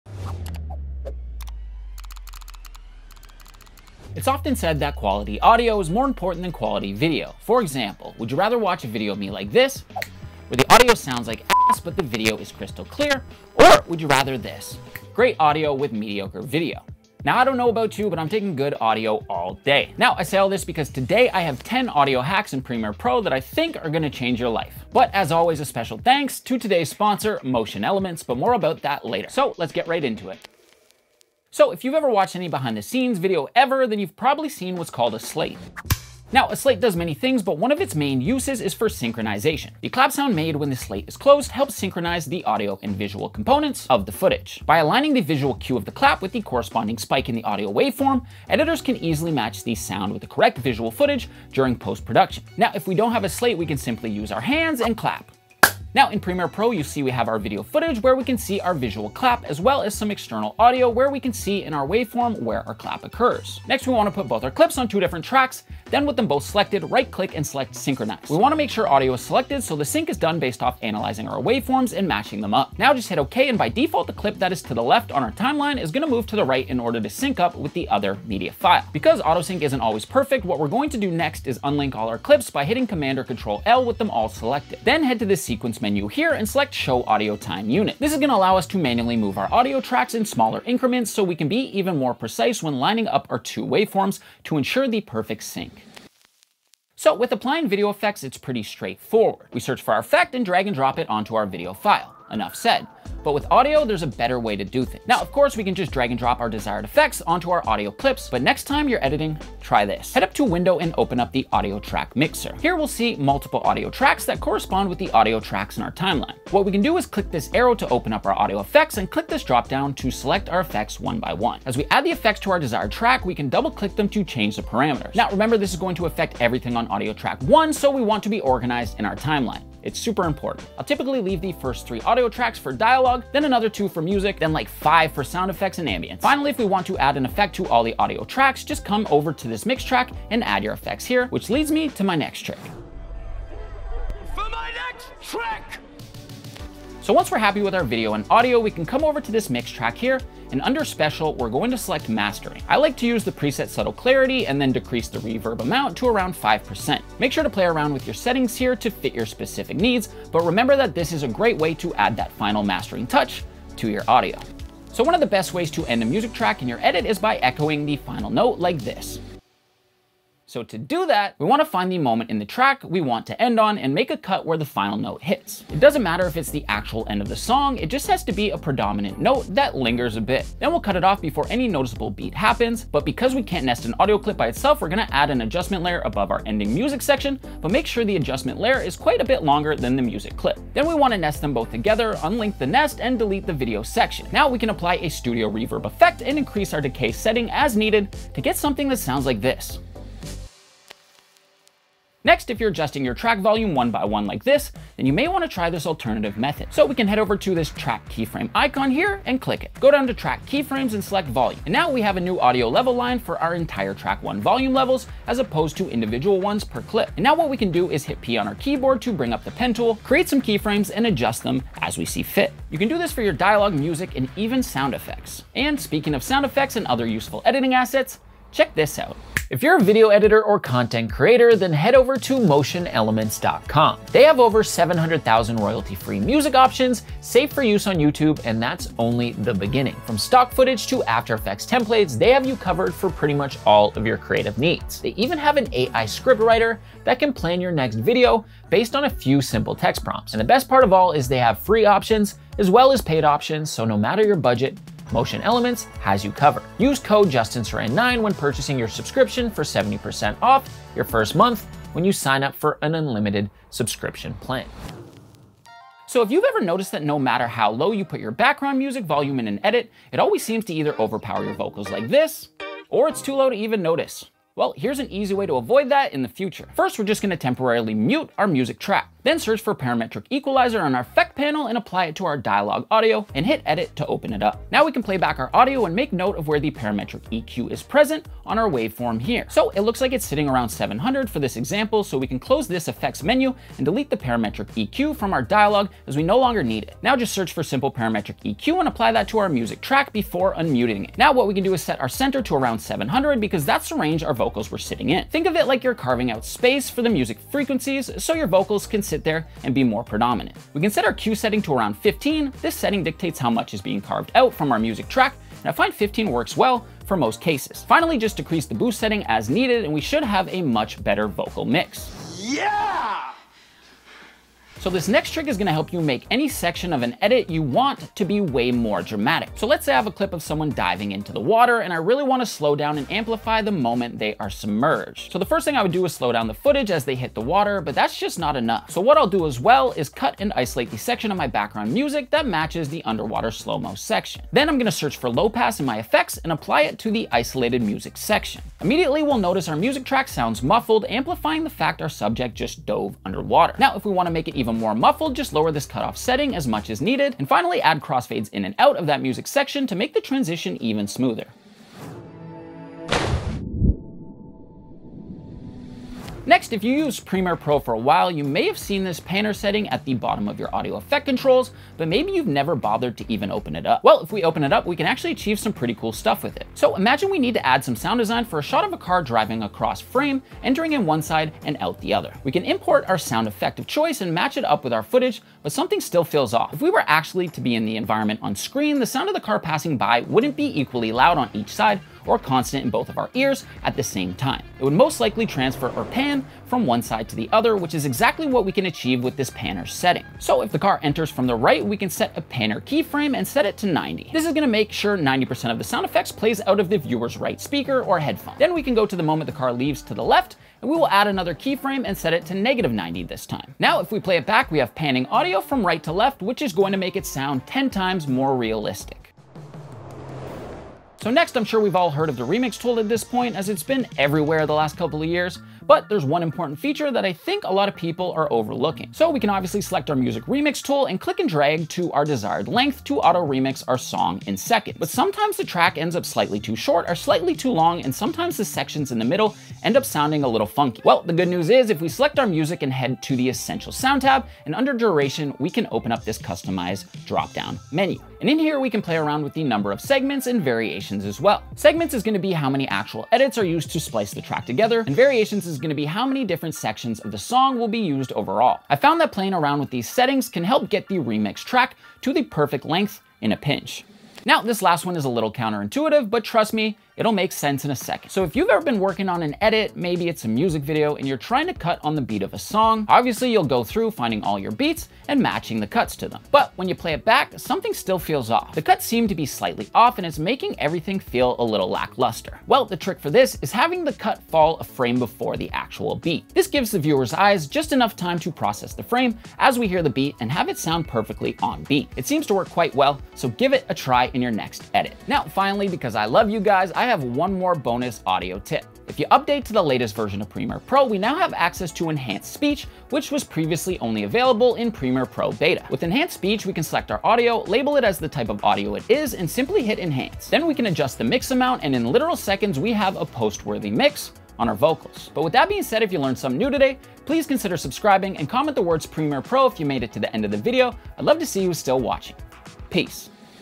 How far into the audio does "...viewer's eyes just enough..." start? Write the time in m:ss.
8:06.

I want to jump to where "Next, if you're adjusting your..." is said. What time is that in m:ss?
3:22.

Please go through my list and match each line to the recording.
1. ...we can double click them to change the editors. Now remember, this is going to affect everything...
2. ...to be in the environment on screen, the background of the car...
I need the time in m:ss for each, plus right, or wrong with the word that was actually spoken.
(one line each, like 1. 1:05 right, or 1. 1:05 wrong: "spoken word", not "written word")
1. 2:03 wrong: "parameters", not "editors"
2. 6:27 wrong: "sound", not "background".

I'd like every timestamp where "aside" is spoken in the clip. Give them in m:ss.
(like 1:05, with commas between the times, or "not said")
not said.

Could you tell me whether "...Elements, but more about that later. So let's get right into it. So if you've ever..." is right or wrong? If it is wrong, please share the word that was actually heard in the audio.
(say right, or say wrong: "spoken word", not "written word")
right.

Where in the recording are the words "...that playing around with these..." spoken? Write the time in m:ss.
7:39.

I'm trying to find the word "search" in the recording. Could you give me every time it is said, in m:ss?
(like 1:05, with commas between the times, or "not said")
1:39, 4:39, 4:57, 5:44.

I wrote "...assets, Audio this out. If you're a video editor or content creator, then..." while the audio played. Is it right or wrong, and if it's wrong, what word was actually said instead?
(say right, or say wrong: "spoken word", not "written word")
wrong: "Check", not "Audio".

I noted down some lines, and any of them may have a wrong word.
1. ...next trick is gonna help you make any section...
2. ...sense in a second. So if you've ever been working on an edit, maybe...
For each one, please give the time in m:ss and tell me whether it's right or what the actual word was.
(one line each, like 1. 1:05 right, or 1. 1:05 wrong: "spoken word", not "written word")
1. 5:25 right
2. 7:47 right.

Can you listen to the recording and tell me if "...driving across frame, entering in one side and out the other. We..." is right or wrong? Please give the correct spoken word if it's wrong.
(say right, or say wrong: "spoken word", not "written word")
right.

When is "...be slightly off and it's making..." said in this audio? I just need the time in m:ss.
7:59.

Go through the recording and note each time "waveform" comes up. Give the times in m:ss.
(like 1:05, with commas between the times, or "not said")
0:47, 1:01, 1:11, 1:33, 4:48.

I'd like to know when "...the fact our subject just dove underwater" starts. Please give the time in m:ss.
5:51.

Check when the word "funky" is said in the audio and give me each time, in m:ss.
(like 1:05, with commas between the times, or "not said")
7:20.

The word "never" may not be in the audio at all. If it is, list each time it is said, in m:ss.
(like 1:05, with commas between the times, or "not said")
6:12.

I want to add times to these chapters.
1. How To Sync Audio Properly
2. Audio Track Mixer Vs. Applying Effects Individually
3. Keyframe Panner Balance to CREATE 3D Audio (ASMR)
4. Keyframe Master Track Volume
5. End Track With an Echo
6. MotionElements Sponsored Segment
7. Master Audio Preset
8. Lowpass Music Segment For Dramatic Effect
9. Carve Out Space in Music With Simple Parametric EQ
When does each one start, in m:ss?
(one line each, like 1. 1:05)
1. 0:30
2. 1:35
3. 6:06
4. 3:21
5. 2:44
6. 3:45
7. 2:23
8. 5:24
9. 4:24.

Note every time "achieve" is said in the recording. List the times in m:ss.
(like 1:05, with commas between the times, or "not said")
6:15, 6:38.